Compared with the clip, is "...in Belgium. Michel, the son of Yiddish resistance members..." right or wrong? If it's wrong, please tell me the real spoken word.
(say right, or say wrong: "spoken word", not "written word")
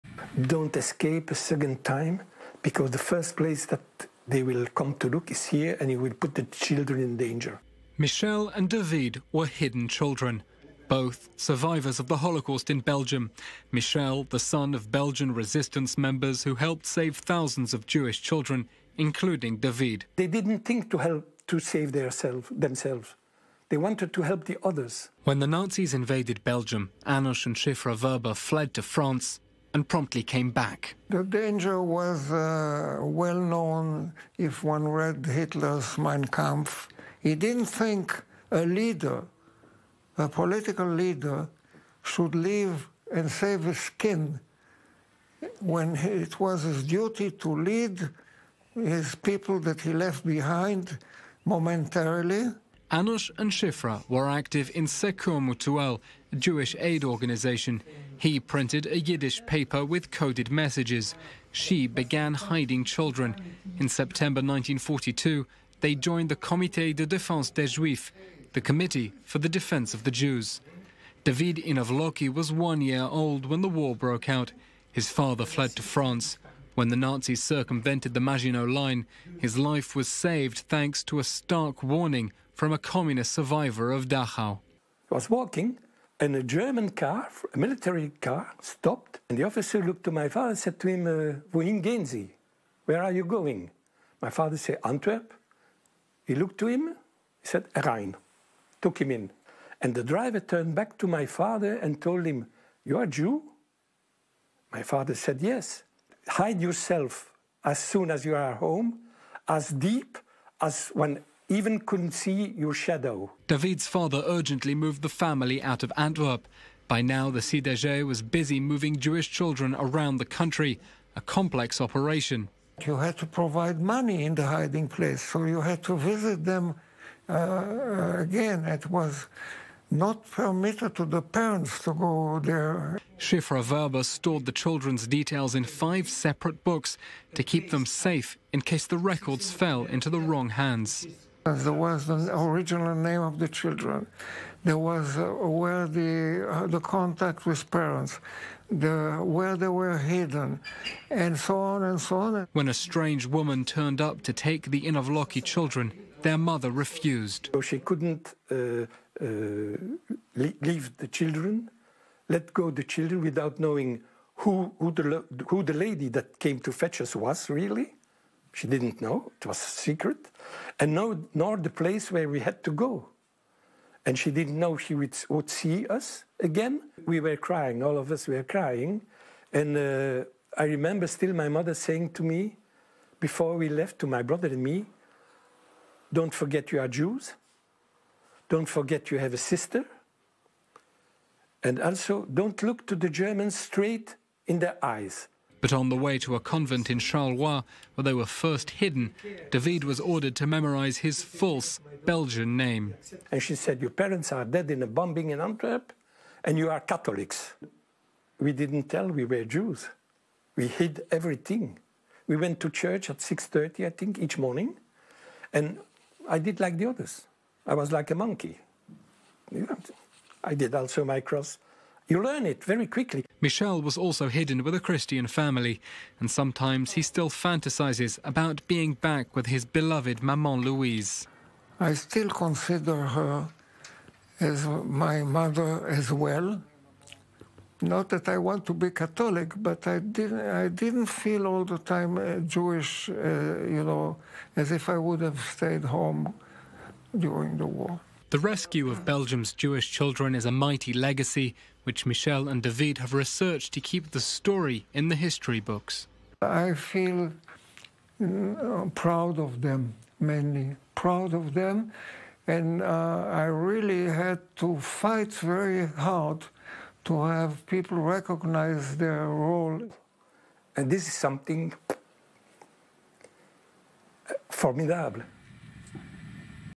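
wrong: "Belgian", not "Yiddish".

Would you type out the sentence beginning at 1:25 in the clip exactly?
I was walking and a German car, a military car, stopped.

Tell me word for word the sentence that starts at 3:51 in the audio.
I still consider her as my mother as well.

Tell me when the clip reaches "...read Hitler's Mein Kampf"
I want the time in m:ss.
0:34.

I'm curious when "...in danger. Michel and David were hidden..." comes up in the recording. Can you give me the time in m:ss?
0:07.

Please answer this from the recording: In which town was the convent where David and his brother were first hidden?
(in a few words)
Charleroi.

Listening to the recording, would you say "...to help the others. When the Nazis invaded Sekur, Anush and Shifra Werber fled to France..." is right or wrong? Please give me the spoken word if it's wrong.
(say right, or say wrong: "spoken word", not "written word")
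wrong: "Belgium", not "Sekur".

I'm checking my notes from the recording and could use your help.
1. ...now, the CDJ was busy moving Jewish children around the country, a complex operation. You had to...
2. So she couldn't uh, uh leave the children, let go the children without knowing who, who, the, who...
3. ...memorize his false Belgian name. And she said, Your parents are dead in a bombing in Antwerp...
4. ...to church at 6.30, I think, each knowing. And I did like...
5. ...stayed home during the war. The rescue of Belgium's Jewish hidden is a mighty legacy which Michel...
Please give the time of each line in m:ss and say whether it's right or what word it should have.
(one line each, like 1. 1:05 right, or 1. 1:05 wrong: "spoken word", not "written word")
1. 1:57 right
2. 2:37 right
3. 3:20 right
4. 3:32 wrong: "morning", not "knowing"
5. 4:05 wrong: "children", not "hidden".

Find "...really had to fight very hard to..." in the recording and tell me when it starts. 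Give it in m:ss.
4:23.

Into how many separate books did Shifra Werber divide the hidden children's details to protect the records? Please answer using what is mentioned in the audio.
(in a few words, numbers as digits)
5.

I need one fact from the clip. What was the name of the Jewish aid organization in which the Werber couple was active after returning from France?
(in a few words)
Sekur Mutuel.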